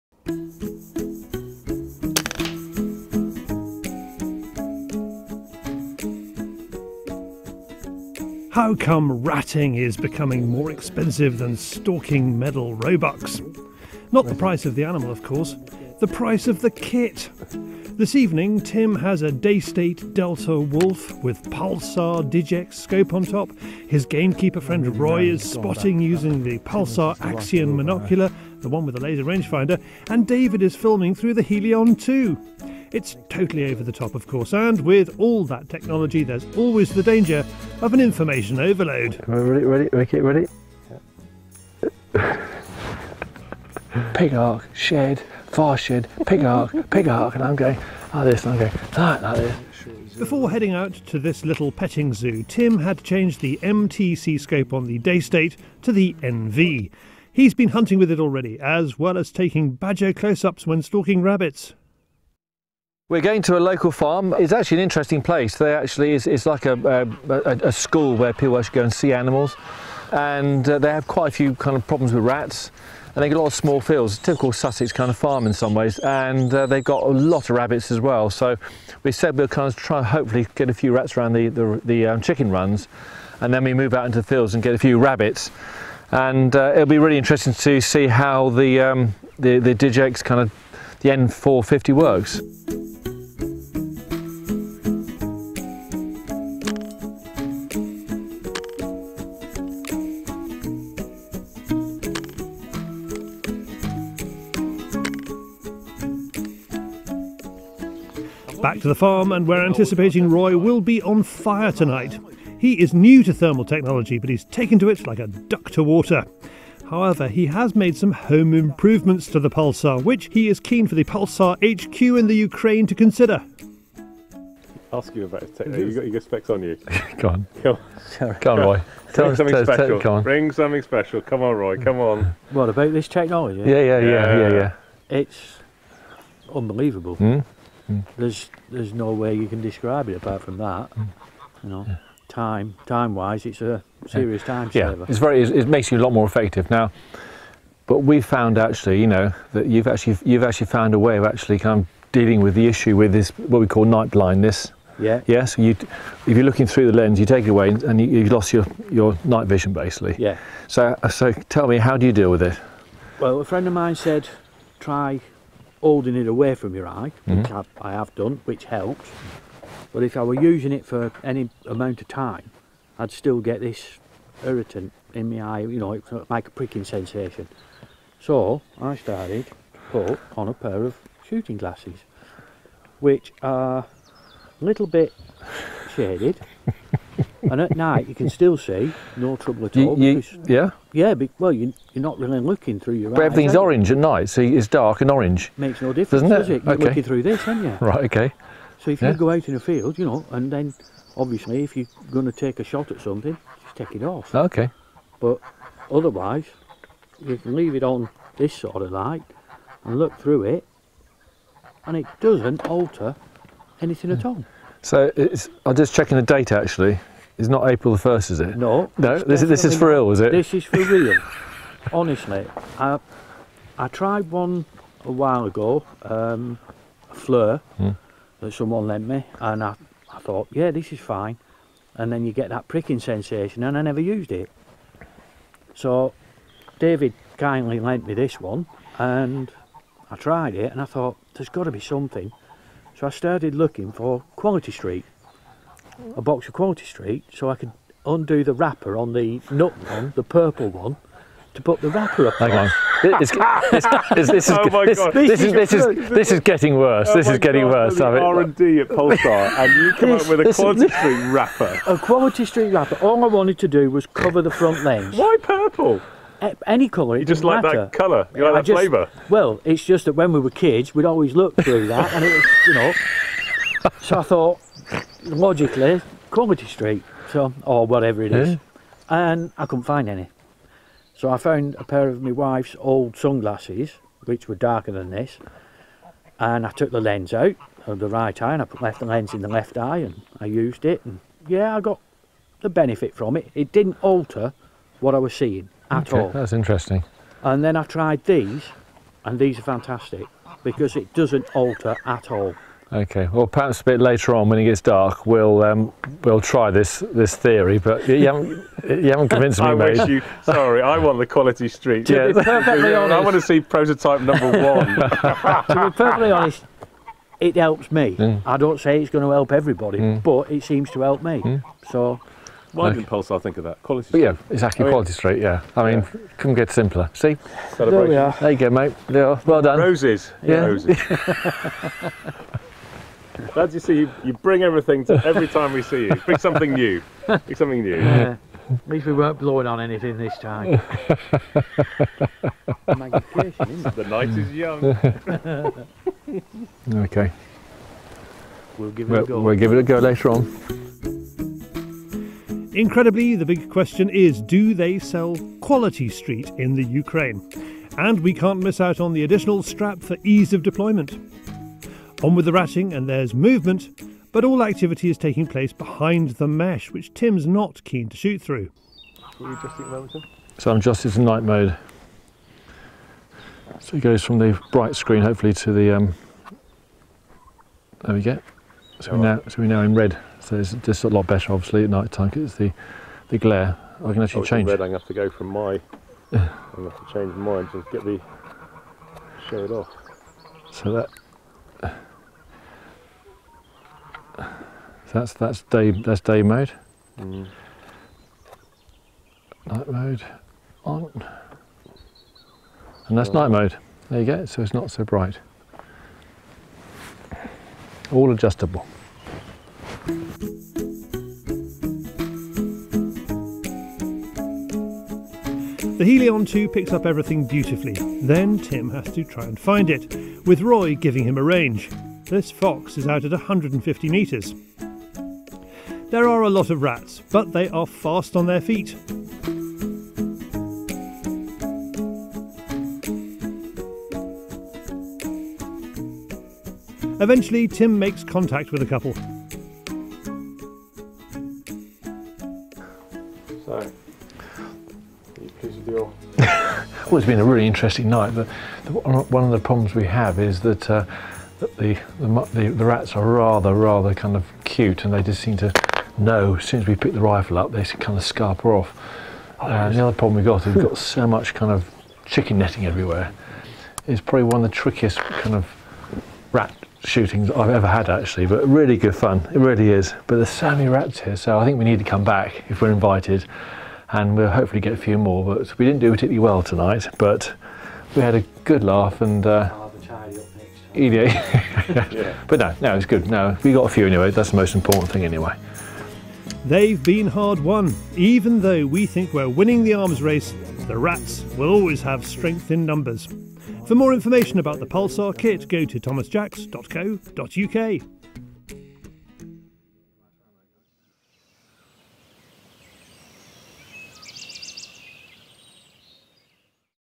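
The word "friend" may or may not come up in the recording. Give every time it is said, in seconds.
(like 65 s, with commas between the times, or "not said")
24 s, 163 s.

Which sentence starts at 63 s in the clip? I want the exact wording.
We're going to a local farm.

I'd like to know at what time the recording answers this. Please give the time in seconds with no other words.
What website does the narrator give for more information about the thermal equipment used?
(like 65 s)
495 s.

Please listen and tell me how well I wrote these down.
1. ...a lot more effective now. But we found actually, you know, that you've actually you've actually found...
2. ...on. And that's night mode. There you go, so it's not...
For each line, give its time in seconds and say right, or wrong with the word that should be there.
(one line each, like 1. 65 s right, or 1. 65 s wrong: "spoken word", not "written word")
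1. 145 s right
2. 400 s right.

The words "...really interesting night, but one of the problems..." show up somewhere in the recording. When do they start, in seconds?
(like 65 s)
447 s.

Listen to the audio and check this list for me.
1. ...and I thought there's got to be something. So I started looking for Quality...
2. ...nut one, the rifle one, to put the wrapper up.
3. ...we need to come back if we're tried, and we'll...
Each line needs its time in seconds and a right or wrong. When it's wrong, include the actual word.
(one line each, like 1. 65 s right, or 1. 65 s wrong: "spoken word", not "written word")
1. 240 s right
2. 249 s wrong: "purple", not "rifle"
3. 471 s wrong: "invited", not "tried".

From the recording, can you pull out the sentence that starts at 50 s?
Before heading out to this little petting zoo, Tim had changed the MTC scope on the Daystate to the NV.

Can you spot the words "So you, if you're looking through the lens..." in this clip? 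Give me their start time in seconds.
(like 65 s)
155 s.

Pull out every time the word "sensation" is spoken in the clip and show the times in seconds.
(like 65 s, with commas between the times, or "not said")
176 s, 232 s.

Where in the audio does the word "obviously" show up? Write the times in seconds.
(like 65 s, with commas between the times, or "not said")
201 s, 381 s.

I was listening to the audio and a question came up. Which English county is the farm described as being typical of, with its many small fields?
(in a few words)
Sussex.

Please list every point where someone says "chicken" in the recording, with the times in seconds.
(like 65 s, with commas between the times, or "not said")
82 s, 462 s.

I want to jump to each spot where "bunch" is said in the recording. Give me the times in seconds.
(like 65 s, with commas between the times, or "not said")
not said.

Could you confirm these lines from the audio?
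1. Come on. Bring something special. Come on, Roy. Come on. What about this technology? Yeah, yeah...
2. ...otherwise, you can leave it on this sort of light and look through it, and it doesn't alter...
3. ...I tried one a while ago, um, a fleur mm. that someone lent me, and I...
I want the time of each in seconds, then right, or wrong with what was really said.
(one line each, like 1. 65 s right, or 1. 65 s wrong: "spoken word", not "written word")
1. 129 s right
2. 205 s right
3. 223 s right.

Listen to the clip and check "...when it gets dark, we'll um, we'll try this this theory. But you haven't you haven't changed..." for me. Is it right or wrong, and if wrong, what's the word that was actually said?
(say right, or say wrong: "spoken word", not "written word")
wrong: "convinced", not "changed".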